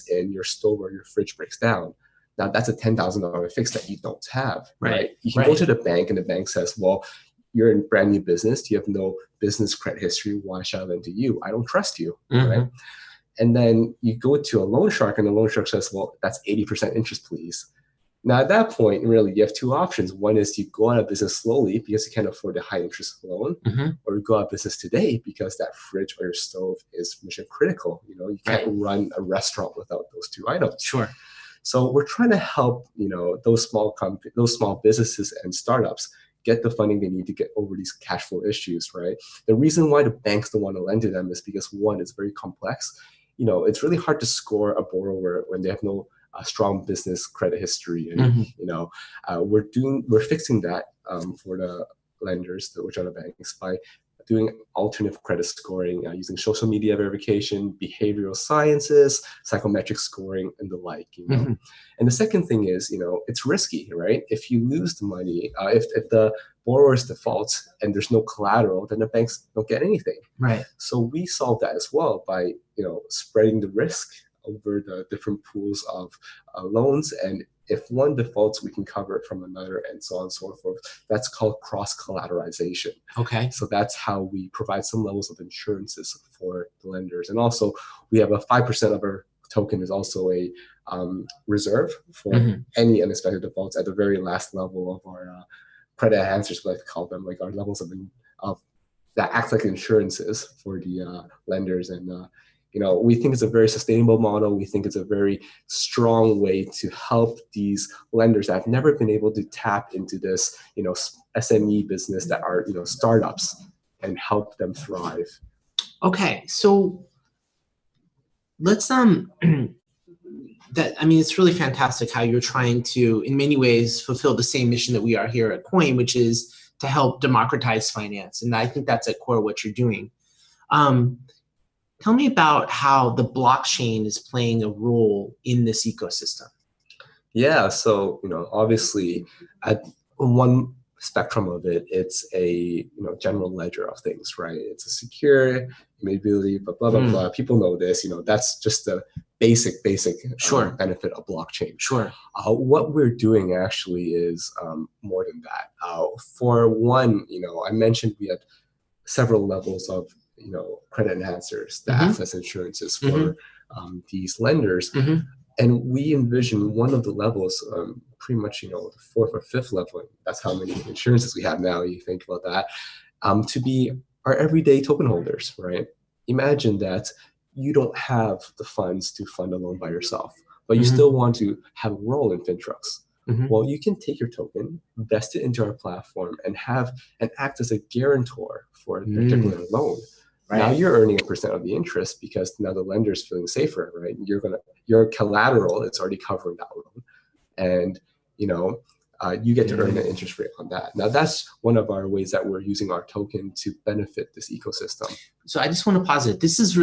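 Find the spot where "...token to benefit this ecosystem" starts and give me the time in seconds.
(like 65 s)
203 s.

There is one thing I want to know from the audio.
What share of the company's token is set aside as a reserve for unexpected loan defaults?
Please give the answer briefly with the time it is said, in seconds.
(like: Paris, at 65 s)
5%, at 88 s.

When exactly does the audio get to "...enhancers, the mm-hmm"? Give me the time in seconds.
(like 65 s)
161 s.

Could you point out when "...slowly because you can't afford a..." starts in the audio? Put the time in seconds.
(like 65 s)
21 s.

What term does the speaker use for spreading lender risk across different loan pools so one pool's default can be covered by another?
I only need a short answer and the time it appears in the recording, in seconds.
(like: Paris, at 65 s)
Cross collateralization, at 81 s.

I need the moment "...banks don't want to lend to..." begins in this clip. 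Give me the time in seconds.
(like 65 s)
40 s.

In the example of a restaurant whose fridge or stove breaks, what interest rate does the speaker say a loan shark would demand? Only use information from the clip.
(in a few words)
80%.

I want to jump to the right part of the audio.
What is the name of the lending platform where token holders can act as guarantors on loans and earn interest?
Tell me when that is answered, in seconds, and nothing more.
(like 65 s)
182 s.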